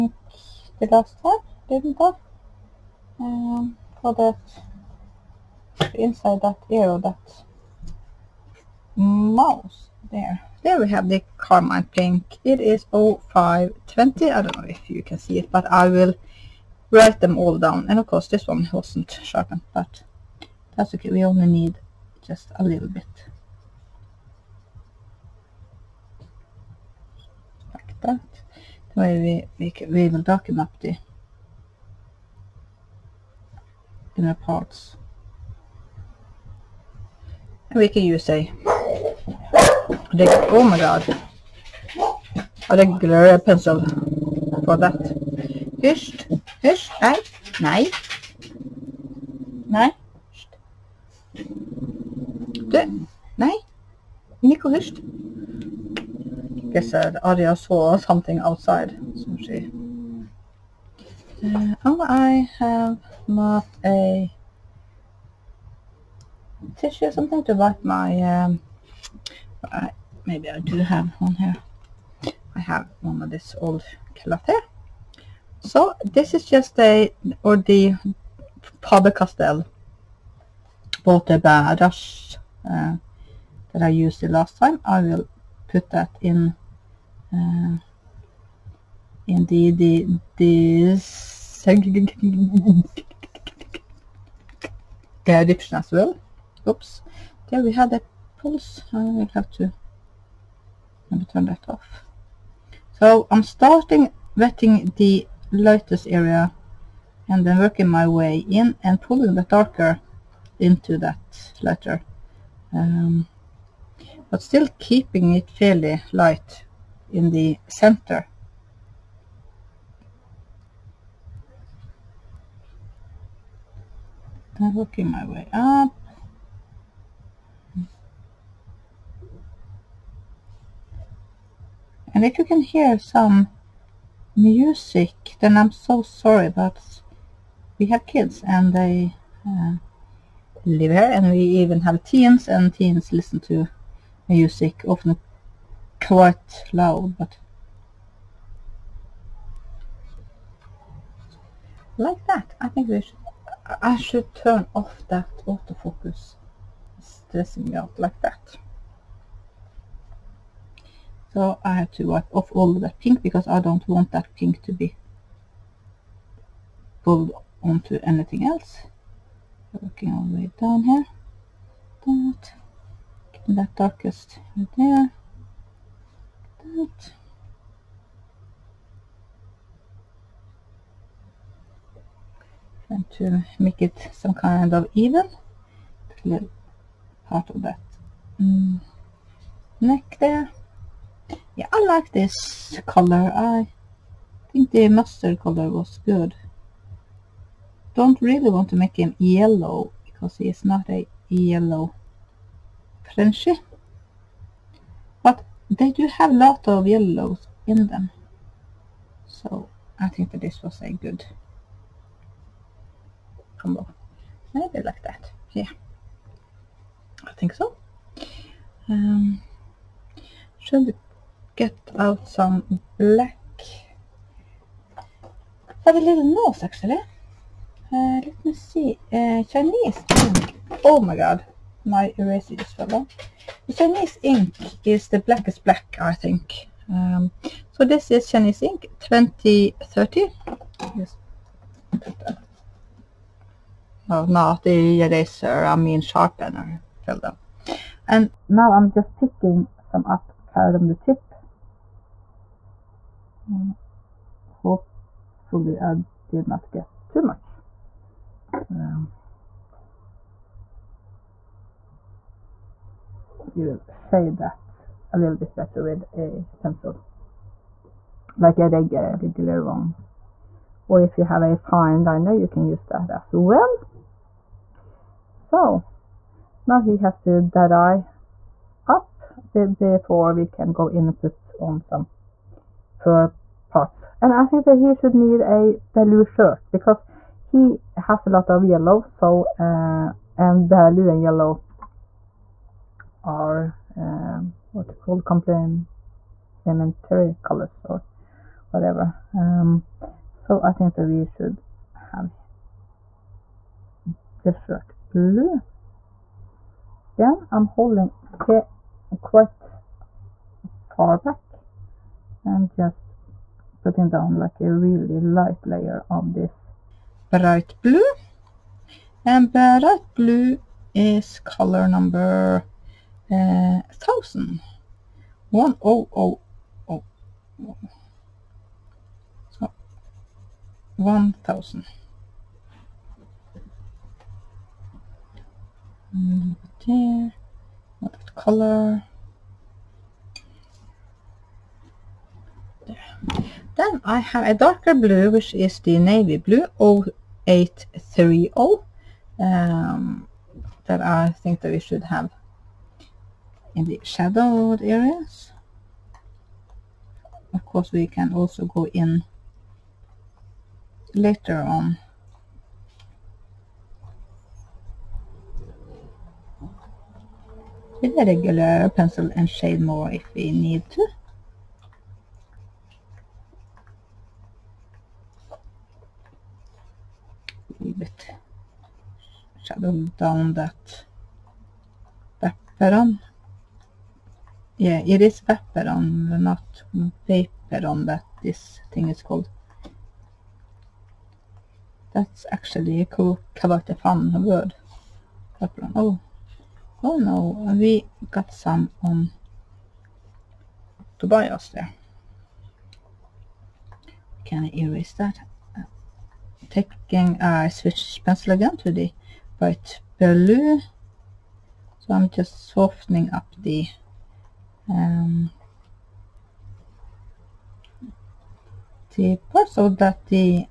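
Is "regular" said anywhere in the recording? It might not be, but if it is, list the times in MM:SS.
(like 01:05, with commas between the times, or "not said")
00:42, 04:29, 06:08.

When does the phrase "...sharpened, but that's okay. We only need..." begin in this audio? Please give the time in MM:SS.
00:19.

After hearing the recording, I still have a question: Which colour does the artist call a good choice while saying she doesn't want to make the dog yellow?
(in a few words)
Mustard.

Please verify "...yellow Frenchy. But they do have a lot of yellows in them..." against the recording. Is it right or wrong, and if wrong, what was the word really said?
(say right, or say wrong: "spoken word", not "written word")
right.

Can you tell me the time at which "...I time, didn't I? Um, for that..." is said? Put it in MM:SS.
00:00.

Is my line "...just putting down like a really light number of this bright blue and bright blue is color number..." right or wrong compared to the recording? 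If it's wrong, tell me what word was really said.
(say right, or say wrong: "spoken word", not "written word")
wrong: "layer", not "number".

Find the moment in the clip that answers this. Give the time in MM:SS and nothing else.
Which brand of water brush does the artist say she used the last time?
01:18.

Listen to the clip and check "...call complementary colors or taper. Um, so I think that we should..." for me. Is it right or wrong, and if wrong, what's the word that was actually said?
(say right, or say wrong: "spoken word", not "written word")
wrong: "whatever", not "taper".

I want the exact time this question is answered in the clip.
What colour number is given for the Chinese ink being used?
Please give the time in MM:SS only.
03:58.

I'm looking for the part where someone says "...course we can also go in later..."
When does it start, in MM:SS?
05:57.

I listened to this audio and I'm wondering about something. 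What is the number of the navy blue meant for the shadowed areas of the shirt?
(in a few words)
0830.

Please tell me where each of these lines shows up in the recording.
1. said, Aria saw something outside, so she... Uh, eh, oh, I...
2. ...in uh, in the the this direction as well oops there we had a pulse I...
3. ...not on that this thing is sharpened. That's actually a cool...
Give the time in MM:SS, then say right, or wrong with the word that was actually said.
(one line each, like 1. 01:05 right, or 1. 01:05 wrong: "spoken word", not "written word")
1. 00:56 right
2. 01:26 right
3. 06:25 wrong: "called", not "sharpened".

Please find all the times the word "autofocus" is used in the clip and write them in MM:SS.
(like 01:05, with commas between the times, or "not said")
02:35.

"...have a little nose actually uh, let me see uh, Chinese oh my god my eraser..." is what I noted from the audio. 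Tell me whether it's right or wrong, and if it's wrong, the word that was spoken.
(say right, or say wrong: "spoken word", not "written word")
right.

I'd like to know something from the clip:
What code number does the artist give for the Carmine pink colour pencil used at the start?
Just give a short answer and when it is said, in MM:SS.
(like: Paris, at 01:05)
0520, at 00:12.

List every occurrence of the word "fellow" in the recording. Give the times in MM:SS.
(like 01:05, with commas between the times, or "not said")
03:52, 04:07.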